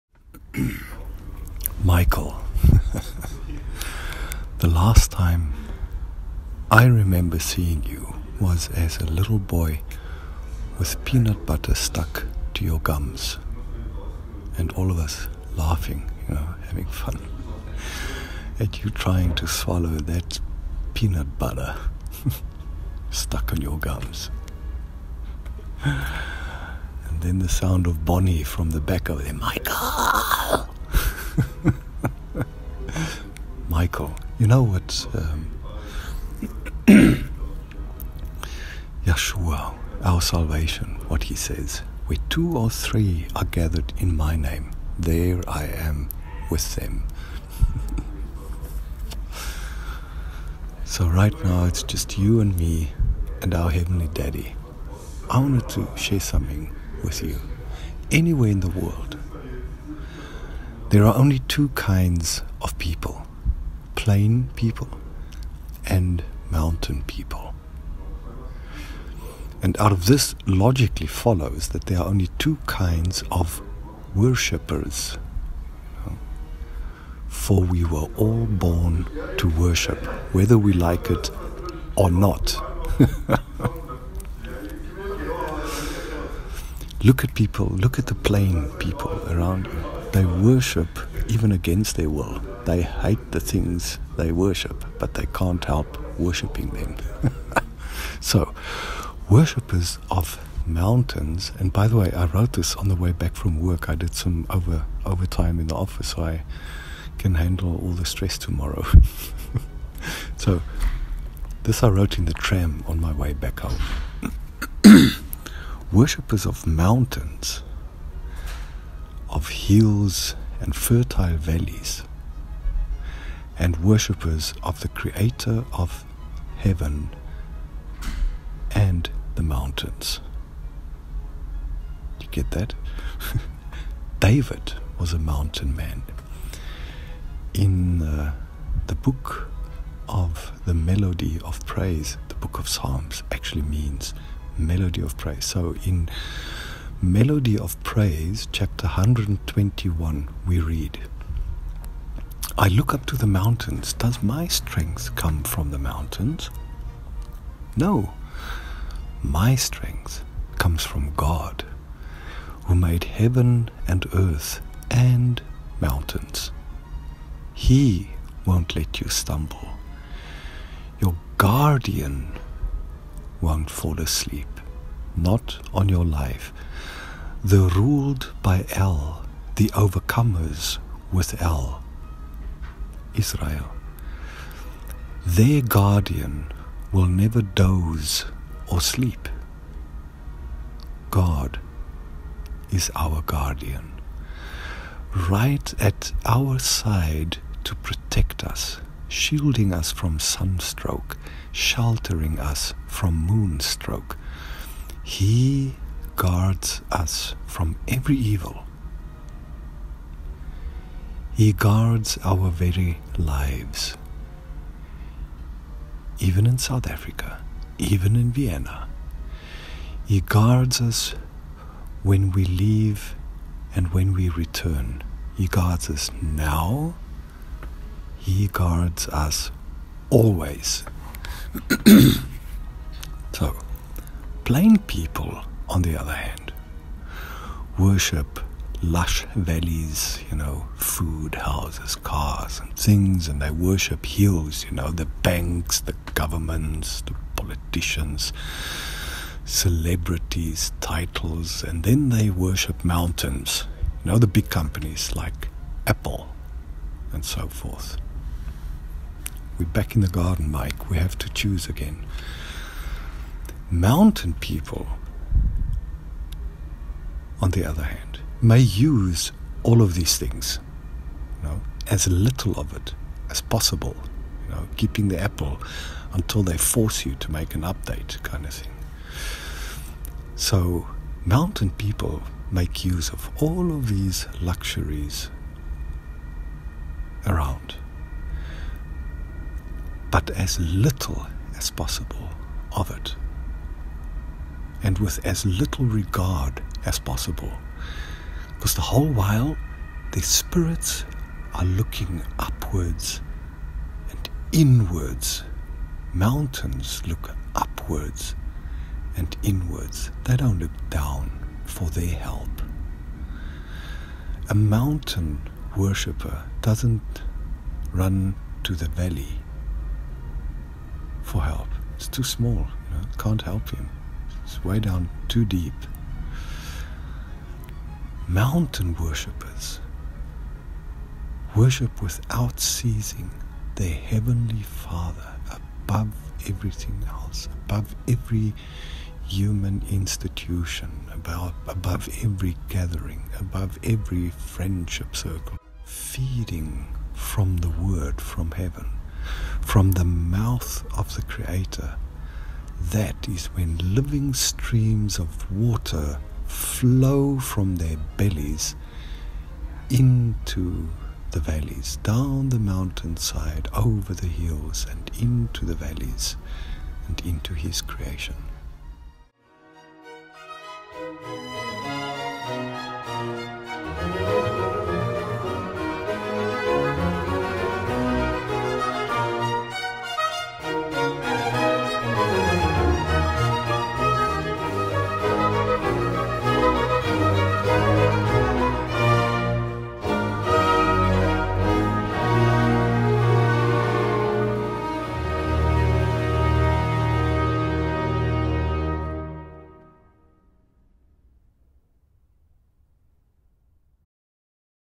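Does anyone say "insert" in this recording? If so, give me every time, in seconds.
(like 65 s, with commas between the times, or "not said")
not said.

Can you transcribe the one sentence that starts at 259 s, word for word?
We're back in the garden, Mike.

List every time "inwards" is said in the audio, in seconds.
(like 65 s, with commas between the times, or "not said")
304 s, 309 s.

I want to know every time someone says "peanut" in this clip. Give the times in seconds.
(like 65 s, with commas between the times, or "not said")
11 s, 20 s.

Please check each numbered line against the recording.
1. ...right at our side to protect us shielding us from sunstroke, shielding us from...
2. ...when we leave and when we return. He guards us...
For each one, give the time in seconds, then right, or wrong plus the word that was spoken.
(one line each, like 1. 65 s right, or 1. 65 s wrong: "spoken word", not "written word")
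1. 195 s wrong: "sheltering", not "shielding"
2. 222 s right.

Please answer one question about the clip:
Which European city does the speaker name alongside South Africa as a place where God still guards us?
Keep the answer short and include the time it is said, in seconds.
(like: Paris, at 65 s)
Vienna, at 218 s.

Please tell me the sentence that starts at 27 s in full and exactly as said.
And then the sound of Bonnie from the back of him, Michael!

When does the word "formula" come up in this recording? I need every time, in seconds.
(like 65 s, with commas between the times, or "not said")
not said.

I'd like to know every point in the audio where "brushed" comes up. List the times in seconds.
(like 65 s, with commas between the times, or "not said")
not said.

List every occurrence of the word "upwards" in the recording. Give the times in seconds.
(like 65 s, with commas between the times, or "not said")
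302 s, 307 s.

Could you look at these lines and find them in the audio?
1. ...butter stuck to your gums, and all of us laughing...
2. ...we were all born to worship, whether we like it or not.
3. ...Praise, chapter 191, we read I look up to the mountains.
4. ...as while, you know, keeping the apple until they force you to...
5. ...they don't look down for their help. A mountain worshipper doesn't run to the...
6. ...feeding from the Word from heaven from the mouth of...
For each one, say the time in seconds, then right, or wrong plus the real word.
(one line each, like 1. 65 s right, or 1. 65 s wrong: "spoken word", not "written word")
1. 11 s right
2. 77 s right
3. 147 s wrong: "121", not "191"
4. 273 s wrong: "possible", not "while"
5. 310 s right
6. 345 s right.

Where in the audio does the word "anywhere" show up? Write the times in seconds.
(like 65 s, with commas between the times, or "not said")
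58 s.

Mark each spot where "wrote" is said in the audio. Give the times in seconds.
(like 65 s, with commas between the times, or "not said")
102 s, 111 s.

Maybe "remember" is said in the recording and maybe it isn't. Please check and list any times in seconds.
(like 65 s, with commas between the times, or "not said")
6 s.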